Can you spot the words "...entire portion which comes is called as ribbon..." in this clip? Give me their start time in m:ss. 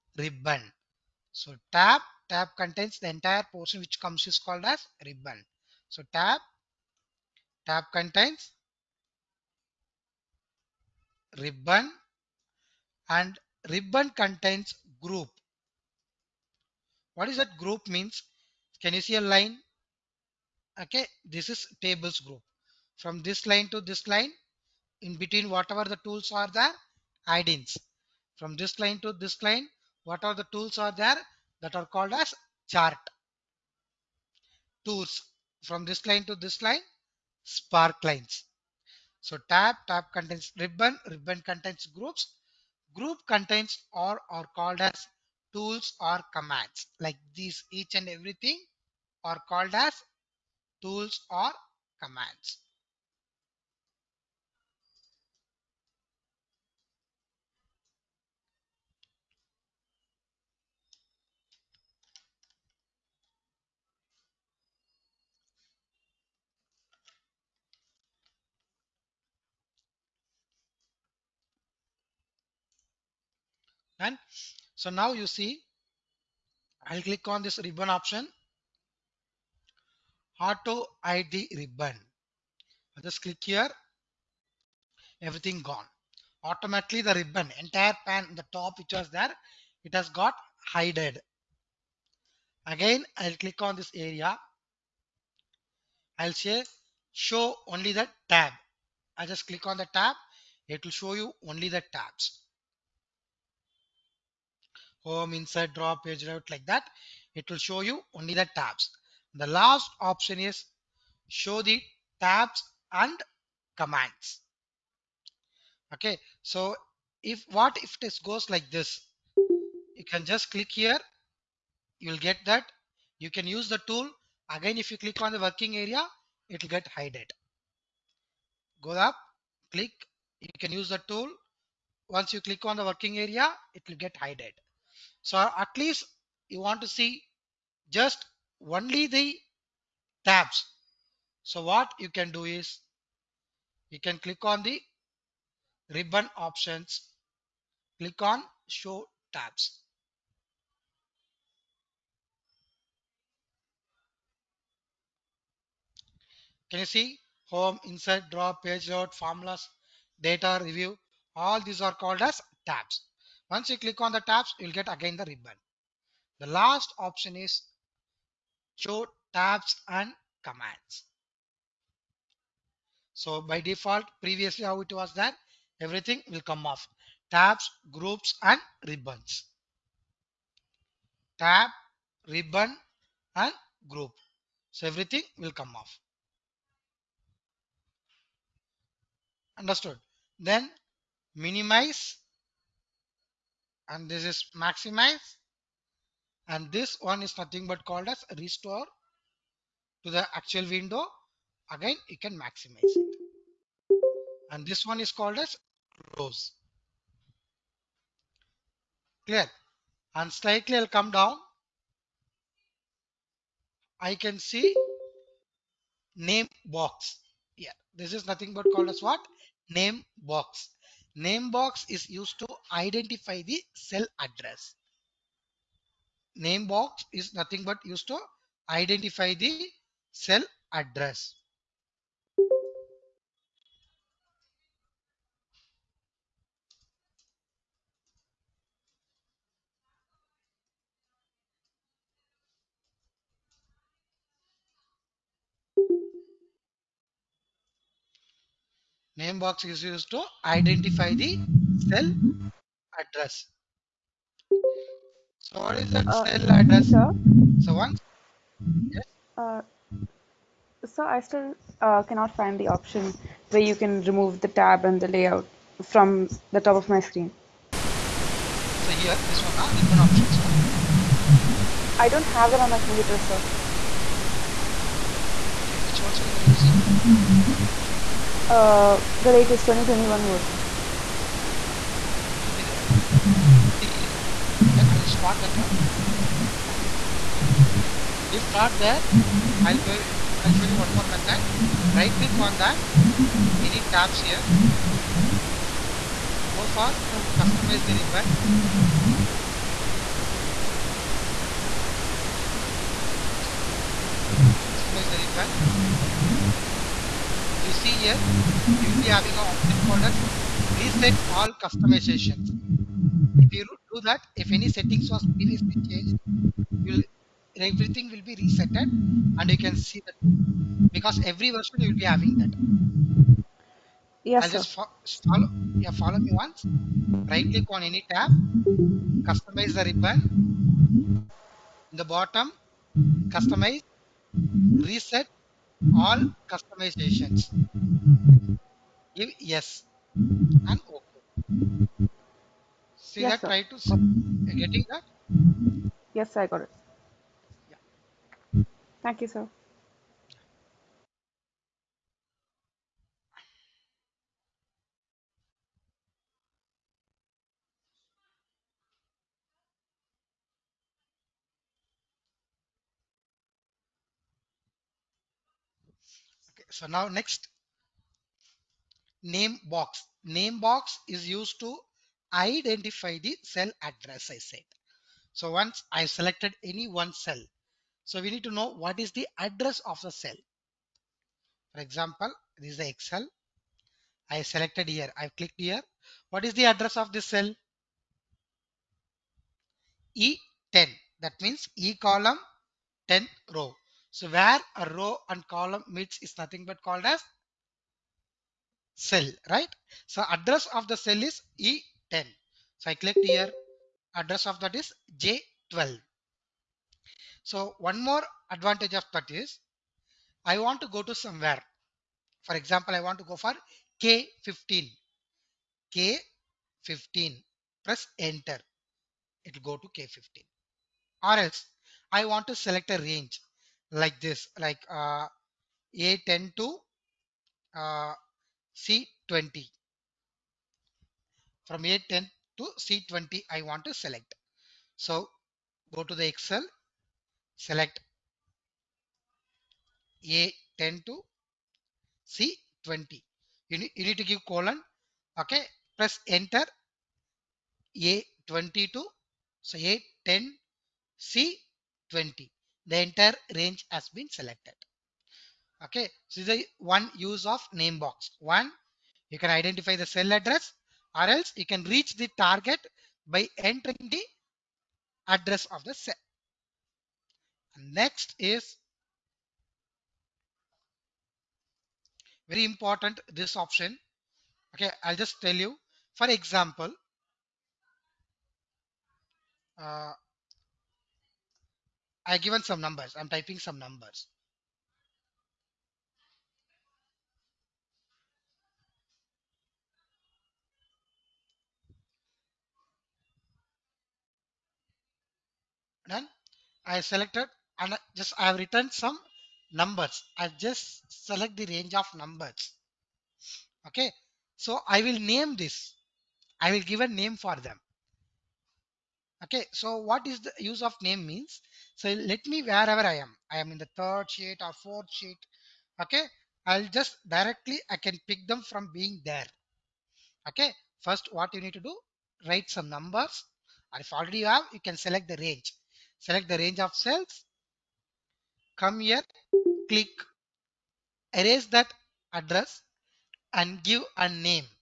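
0:03.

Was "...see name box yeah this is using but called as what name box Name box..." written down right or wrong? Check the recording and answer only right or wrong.
wrong.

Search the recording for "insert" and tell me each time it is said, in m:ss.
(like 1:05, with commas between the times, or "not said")
1:45, 2:37.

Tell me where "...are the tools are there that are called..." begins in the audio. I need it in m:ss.
0:30.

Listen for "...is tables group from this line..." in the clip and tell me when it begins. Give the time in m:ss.
0:21.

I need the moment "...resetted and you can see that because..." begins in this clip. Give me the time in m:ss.
5:18.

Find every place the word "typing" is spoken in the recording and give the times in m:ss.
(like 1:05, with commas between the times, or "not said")
8:03.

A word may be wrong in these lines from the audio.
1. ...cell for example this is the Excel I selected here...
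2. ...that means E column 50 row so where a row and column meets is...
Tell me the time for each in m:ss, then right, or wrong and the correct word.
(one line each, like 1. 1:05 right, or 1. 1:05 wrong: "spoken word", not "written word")
1. 6:20 right
2. 6:31 wrong: "10", not "50".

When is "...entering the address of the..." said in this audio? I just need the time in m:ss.
7:43.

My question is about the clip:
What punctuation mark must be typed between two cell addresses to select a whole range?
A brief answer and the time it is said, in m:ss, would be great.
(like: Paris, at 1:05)
Colon, at 7:24.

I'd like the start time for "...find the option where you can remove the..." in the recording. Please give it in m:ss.
4:22.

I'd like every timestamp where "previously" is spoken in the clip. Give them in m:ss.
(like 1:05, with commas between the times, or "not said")
2:54, 5:15.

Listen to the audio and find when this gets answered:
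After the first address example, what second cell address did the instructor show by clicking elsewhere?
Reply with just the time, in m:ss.
6:45.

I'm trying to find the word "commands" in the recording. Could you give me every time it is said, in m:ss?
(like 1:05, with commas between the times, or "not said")
0:46, 0:52, 1:53, 2:50.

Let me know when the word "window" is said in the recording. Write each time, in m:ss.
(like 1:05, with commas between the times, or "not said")
3:20.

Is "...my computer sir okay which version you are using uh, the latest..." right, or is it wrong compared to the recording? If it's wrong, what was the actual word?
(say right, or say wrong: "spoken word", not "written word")
right.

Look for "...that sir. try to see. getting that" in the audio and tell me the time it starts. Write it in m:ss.
5:43.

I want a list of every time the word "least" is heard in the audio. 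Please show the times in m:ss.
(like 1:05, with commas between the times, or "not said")
2:15.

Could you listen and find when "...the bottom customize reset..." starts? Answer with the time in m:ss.
5:32.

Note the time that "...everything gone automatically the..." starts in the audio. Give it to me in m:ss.
1:25.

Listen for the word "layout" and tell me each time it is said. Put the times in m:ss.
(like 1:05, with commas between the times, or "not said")
1:46, 2:38, 4:25.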